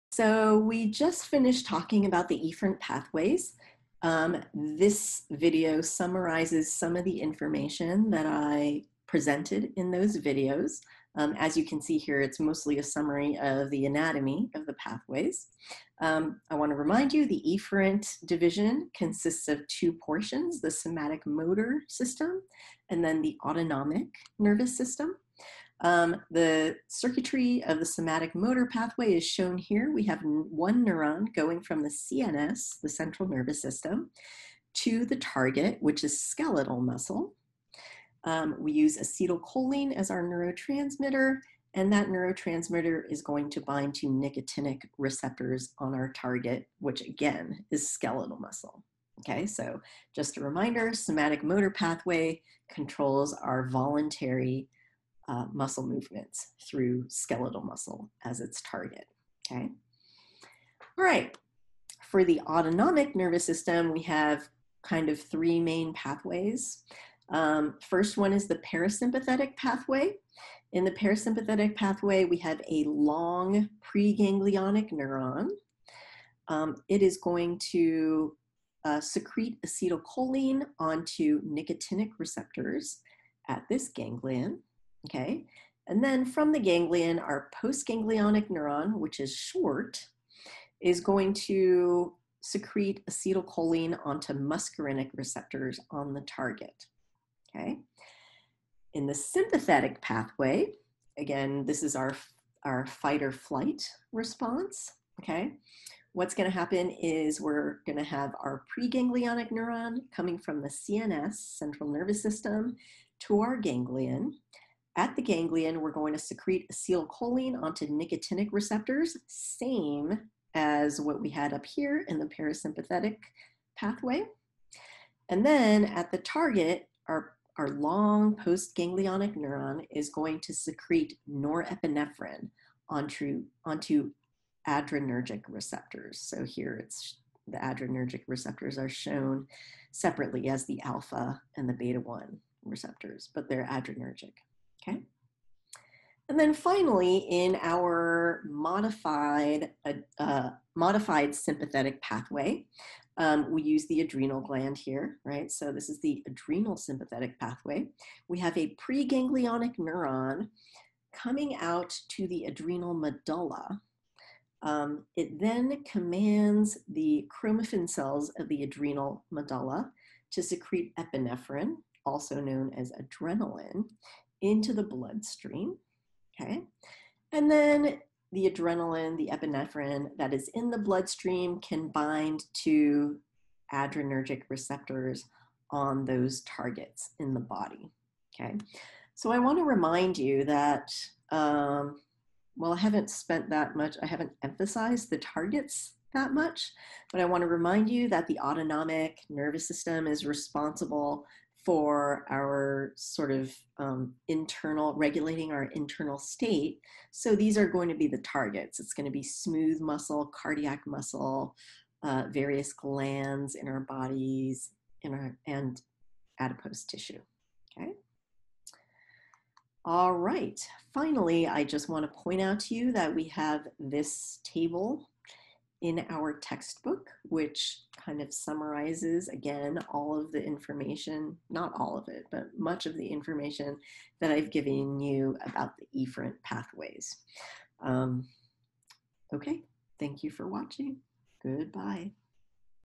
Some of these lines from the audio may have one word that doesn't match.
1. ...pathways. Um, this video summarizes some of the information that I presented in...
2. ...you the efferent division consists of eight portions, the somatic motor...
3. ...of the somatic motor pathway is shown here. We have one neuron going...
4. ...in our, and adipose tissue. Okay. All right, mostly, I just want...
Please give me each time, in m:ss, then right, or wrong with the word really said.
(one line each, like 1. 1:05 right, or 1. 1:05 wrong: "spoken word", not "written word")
1. 0:02 right
2. 0:17 wrong: "two", not "eight"
3. 0:27 right
4. 3:35 wrong: "finally", not "mostly".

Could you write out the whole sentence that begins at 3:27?
So these are going to be the targets.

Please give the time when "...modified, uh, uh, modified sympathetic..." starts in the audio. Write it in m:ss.
2:28.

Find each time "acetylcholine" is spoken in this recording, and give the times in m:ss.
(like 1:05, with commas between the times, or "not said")
0:38, 1:19, 1:33, 1:56.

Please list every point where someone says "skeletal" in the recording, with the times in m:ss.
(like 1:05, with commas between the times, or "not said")
0:36, 0:47, 0:57.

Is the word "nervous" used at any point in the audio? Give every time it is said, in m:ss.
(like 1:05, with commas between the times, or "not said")
0:24, 0:33, 1:03, 1:51, 3:19.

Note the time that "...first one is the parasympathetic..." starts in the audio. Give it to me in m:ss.
1:07.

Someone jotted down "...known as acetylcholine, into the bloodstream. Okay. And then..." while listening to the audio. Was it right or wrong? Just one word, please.
wrong.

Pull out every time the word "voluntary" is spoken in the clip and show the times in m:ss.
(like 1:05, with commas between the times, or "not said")
0:53.